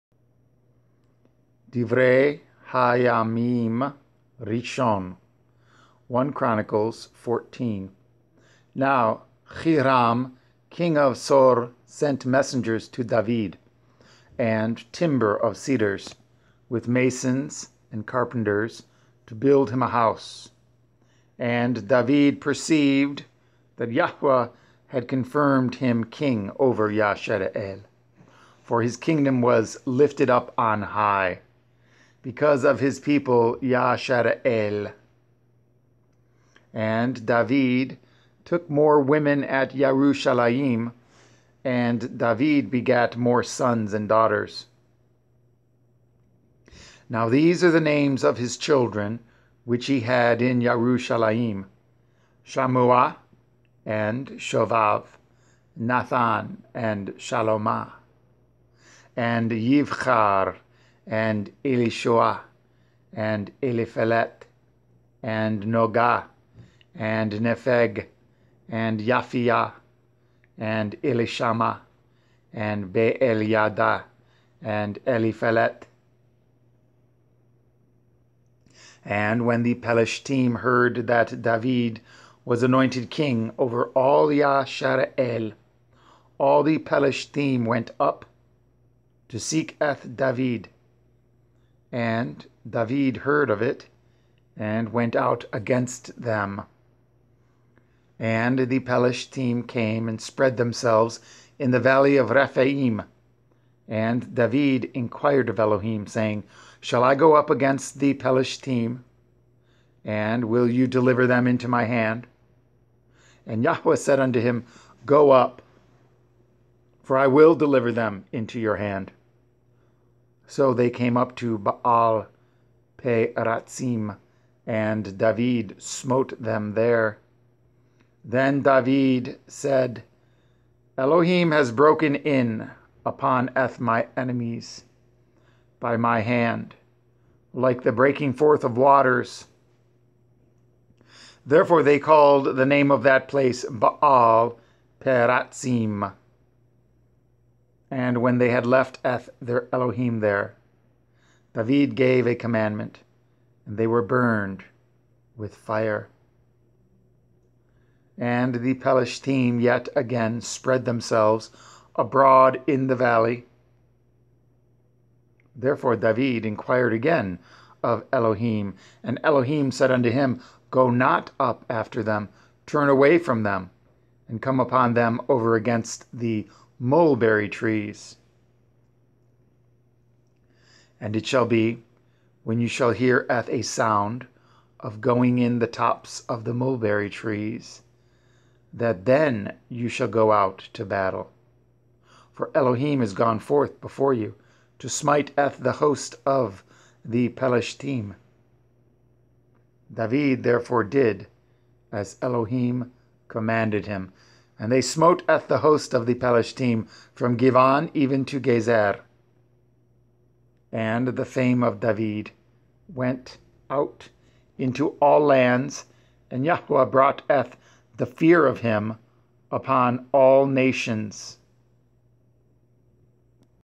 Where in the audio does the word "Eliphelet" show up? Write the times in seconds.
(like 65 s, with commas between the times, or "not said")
63 s, 75 s.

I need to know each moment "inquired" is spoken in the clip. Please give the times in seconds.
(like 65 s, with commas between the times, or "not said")
104 s, 166 s.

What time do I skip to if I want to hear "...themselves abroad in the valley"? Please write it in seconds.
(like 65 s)
160 s.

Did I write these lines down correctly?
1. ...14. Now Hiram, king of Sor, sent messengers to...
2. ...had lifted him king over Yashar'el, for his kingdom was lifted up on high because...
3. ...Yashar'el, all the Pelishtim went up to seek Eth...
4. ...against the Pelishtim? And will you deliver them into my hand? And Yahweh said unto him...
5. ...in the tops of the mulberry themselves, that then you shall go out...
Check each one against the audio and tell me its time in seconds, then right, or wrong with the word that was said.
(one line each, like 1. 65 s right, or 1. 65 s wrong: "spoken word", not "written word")
1. 7 s right
2. 24 s wrong: "confirmed", not "lifted"
3. 84 s right
4. 107 s right
5. 185 s wrong: "trees", not "themselves".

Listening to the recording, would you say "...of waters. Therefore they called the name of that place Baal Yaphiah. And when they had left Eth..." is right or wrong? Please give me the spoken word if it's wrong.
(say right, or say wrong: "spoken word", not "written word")
wrong: "Peratzim", not "Yaphiah".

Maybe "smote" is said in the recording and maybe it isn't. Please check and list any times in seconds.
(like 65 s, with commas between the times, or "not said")
125 s, 204 s.